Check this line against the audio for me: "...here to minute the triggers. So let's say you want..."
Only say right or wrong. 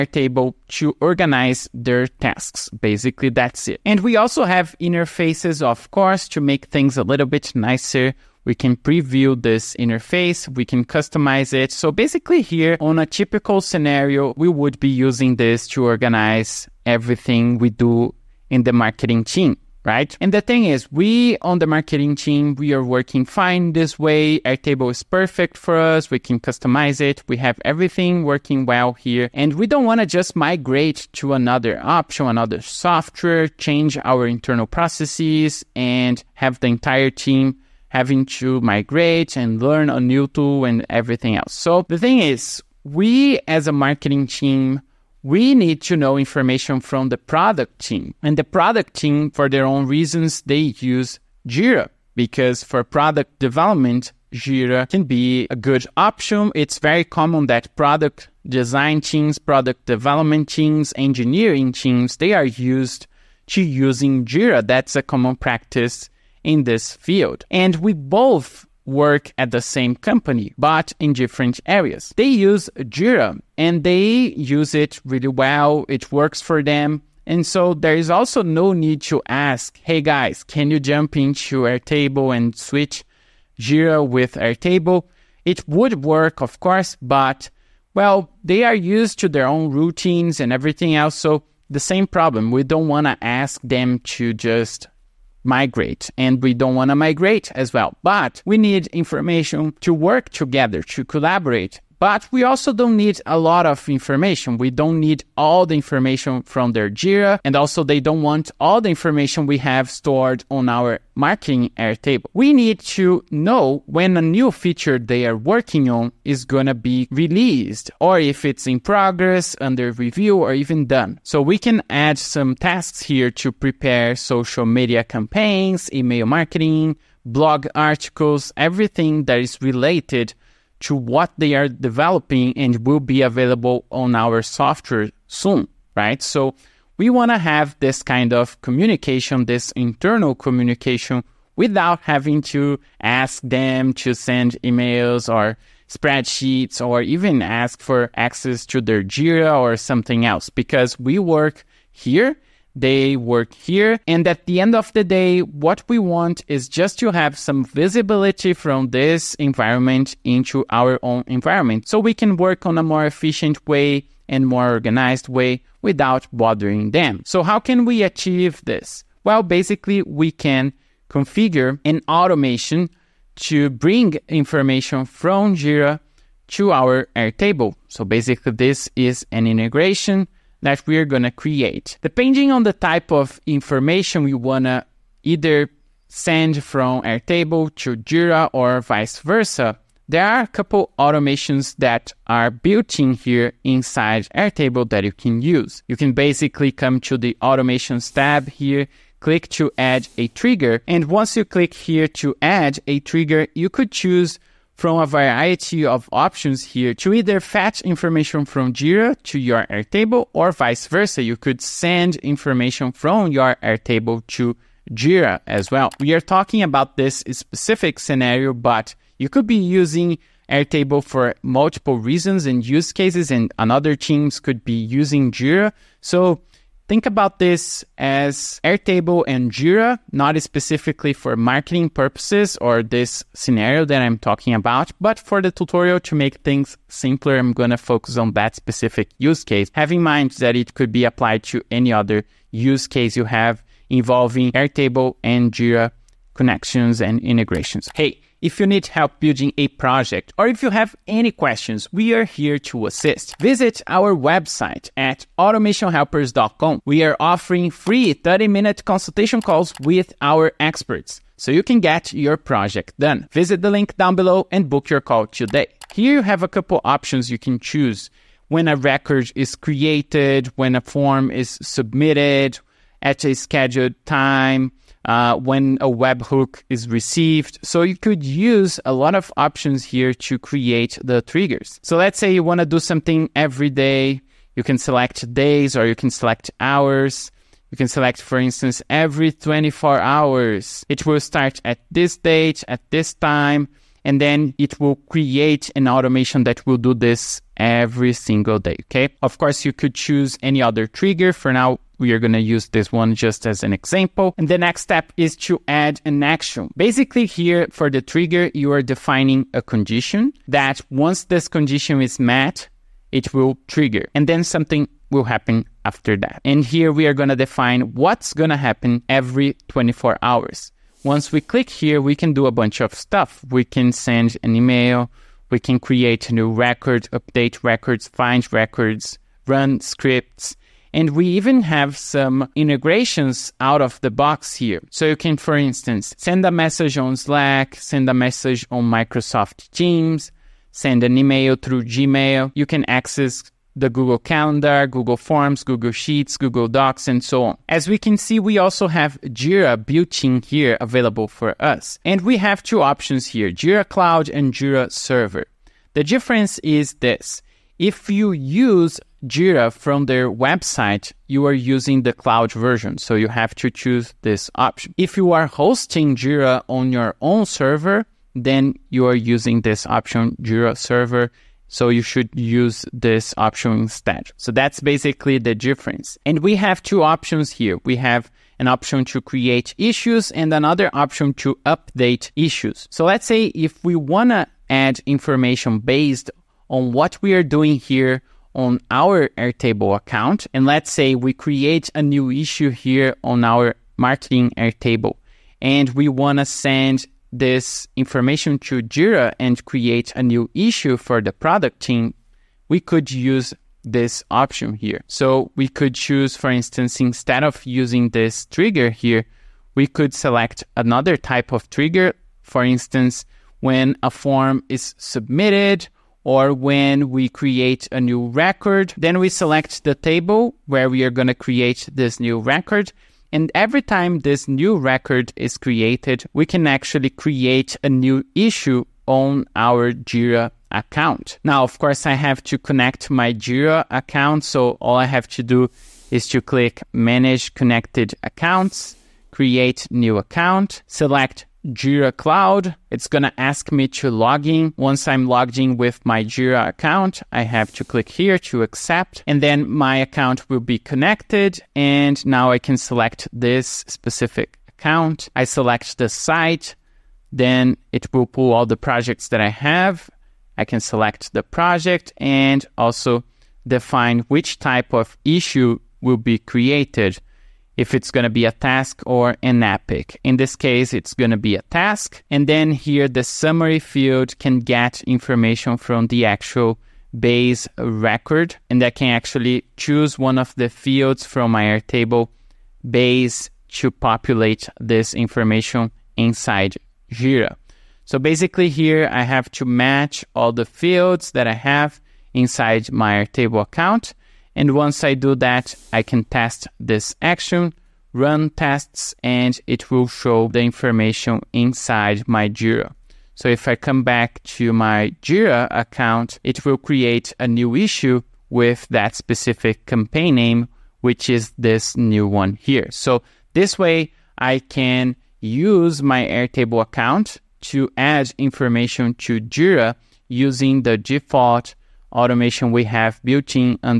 wrong.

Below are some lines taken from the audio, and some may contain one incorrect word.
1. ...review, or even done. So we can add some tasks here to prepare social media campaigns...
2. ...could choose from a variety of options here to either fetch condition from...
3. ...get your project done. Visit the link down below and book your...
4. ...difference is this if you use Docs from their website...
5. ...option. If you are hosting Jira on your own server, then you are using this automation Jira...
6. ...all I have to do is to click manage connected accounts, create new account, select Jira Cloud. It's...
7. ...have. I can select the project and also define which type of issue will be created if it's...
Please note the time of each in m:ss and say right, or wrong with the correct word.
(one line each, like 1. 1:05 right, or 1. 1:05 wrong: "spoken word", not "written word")
1. 1:59 right
2. 3:23 wrong: "information", not "condition"
3. 4:21 right
4. 5:56 wrong: "Jira", not "Docs"
5. 6:04 wrong: "option", not "automation"
6. 7:14 right
7. 7:39 right.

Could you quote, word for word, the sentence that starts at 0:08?
We can preview this interface, we can customize it.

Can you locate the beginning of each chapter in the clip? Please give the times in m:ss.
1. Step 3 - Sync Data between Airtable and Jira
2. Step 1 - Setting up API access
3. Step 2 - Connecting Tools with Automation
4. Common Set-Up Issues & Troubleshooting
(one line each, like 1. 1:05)
1. 5:55
2. 1:45
3. 3:20
4. 8:30.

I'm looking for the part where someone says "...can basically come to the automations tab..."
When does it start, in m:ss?
3:15.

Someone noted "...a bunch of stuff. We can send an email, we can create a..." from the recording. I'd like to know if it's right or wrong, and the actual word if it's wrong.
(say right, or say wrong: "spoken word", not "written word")
right.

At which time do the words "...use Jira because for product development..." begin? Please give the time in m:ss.
0:50.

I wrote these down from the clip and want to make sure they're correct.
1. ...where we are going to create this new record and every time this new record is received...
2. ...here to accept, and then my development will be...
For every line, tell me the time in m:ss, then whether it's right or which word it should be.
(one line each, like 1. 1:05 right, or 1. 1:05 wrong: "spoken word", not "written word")
1. 7:00 wrong: "created", not "received"
2. 7:28 wrong: "account", not "development".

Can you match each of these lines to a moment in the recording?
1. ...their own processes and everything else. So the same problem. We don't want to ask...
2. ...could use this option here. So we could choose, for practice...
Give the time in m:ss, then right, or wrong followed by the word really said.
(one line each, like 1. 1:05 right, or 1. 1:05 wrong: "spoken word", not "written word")
1. 1:29 wrong: "routines", not "processes"
2. 6:42 wrong: "instance", not "practice".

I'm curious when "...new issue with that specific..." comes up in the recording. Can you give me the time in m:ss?
8:27.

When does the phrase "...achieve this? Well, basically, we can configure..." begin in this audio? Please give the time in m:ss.
2:48.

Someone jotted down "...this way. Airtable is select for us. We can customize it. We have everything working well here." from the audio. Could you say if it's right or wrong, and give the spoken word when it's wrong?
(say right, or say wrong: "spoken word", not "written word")
wrong: "perfect", not "select".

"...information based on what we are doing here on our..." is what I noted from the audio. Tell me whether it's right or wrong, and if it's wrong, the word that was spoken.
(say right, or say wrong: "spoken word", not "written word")
right.